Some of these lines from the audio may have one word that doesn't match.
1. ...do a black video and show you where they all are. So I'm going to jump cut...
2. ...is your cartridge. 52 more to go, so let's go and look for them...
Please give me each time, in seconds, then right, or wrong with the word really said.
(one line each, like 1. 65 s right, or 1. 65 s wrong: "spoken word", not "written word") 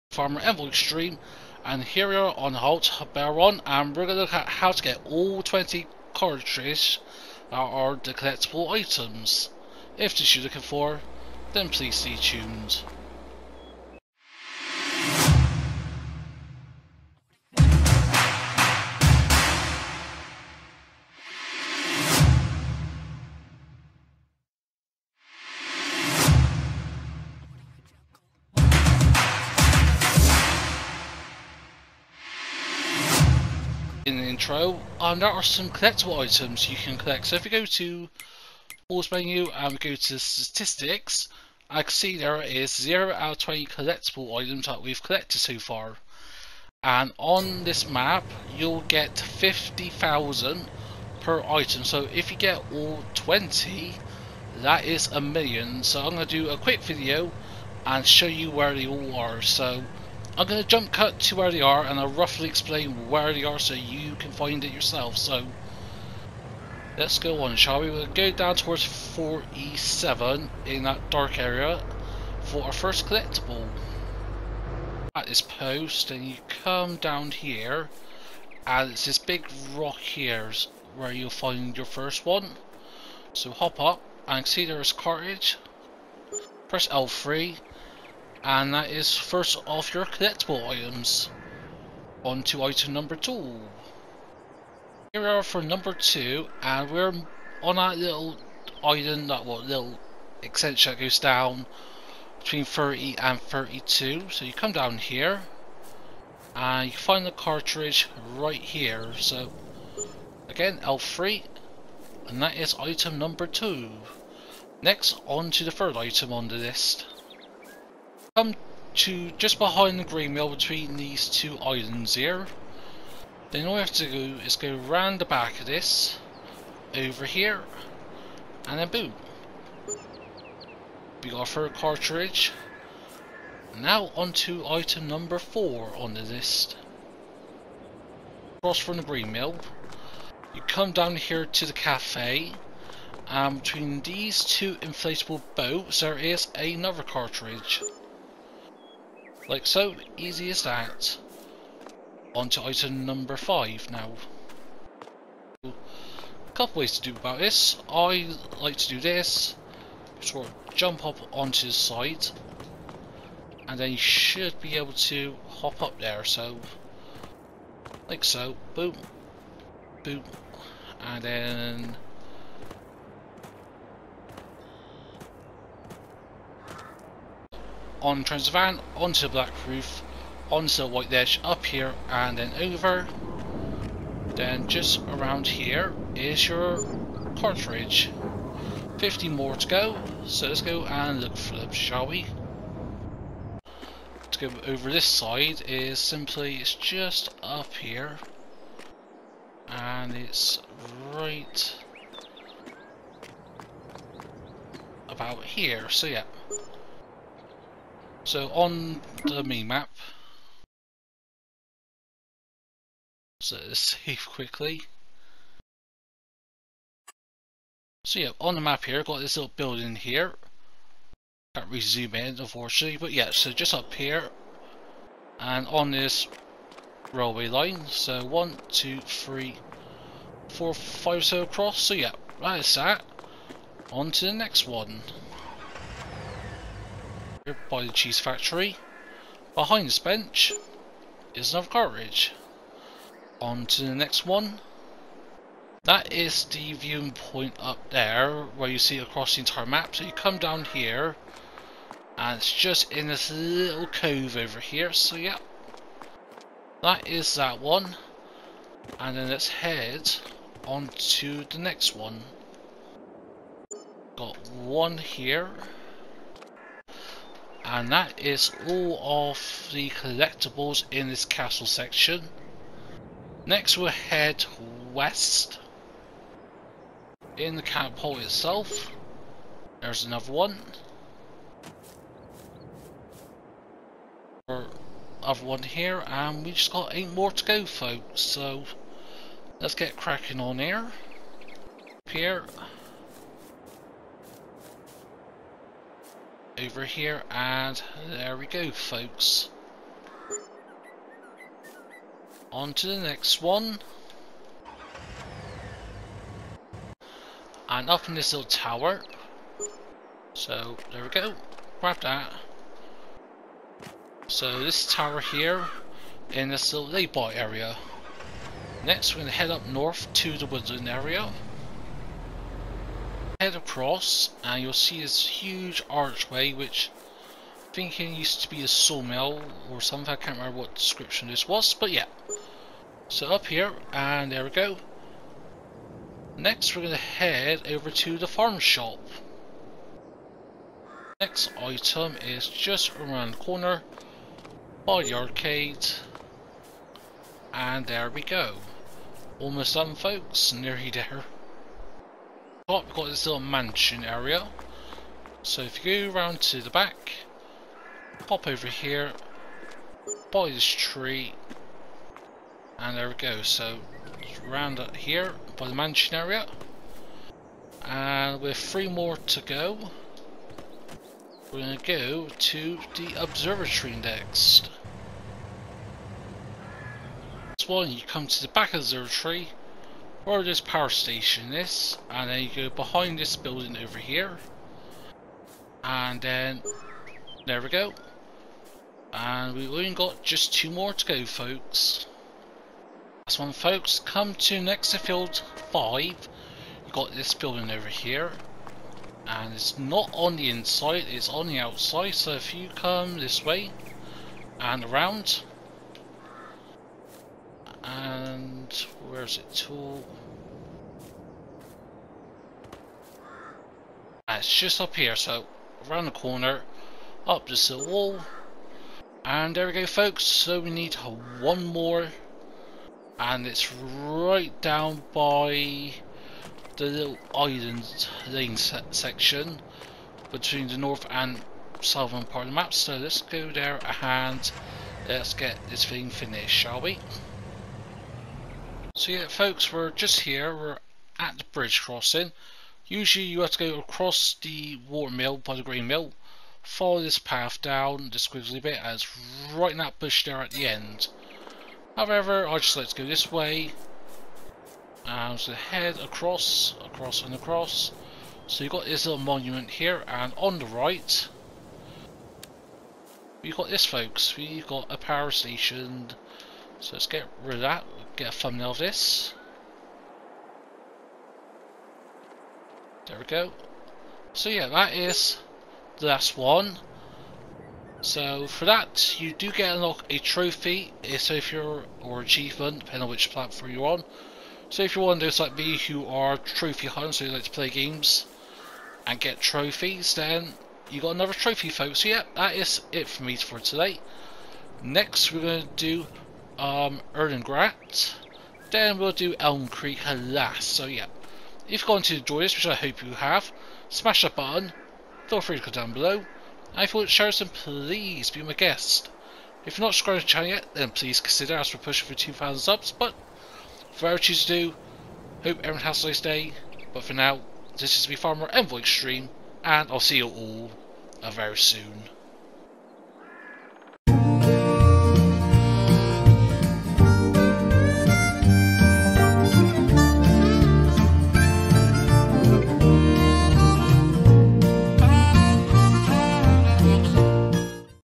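1. 56 s wrong: "quick", not "black"
2. 186 s wrong: "50", not "52".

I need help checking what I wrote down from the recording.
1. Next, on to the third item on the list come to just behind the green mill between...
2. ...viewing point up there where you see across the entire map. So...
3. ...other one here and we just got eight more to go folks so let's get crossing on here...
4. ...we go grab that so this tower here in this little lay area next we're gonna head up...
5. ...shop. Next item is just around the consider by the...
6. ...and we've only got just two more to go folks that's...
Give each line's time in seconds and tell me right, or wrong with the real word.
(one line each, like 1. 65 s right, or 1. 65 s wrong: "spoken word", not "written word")
1. 114 s right
2. 246 s right
3. 285 s wrong: "cracking", not "crossing"
4. 311 s right
5. 338 s wrong: "corner", not "consider"
6. 389 s right.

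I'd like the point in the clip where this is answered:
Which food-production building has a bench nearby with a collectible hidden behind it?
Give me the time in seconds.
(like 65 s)
237 s.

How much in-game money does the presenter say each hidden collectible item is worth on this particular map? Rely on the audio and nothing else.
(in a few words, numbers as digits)
50,000.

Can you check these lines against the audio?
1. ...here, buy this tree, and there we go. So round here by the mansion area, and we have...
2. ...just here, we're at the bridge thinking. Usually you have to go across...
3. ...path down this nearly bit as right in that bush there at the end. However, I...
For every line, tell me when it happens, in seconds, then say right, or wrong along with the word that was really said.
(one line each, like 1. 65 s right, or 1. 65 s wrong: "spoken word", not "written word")
1. 358 s right
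2. 439 s wrong: "crossing", not "thinking"
3. 447 s wrong: "squiggly", not "nearly".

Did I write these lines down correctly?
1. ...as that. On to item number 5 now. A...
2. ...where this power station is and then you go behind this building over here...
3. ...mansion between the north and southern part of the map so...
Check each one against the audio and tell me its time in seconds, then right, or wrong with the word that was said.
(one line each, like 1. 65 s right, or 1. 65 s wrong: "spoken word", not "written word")
1. 150 s right
2. 380 s right
3. 428 s wrong: "section", not "mansion".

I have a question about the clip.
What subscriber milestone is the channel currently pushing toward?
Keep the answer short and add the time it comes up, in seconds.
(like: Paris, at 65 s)
2,000, at 512 s.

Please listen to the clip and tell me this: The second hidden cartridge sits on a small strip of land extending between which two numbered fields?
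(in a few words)
30 and 32.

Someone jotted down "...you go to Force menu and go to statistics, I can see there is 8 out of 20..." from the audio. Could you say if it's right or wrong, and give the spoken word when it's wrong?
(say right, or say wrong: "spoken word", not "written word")
wrong: "0", not "8".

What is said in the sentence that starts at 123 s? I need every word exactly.
Then all we have to do is go round the back of this, over here, and then boom.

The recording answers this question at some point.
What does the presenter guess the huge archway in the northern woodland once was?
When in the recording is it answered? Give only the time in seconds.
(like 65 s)
328 s.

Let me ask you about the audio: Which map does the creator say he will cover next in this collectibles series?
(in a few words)
Erlengrat.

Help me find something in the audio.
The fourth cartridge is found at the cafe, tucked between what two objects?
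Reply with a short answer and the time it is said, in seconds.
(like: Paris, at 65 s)
Two inflatable boats, at 144 s.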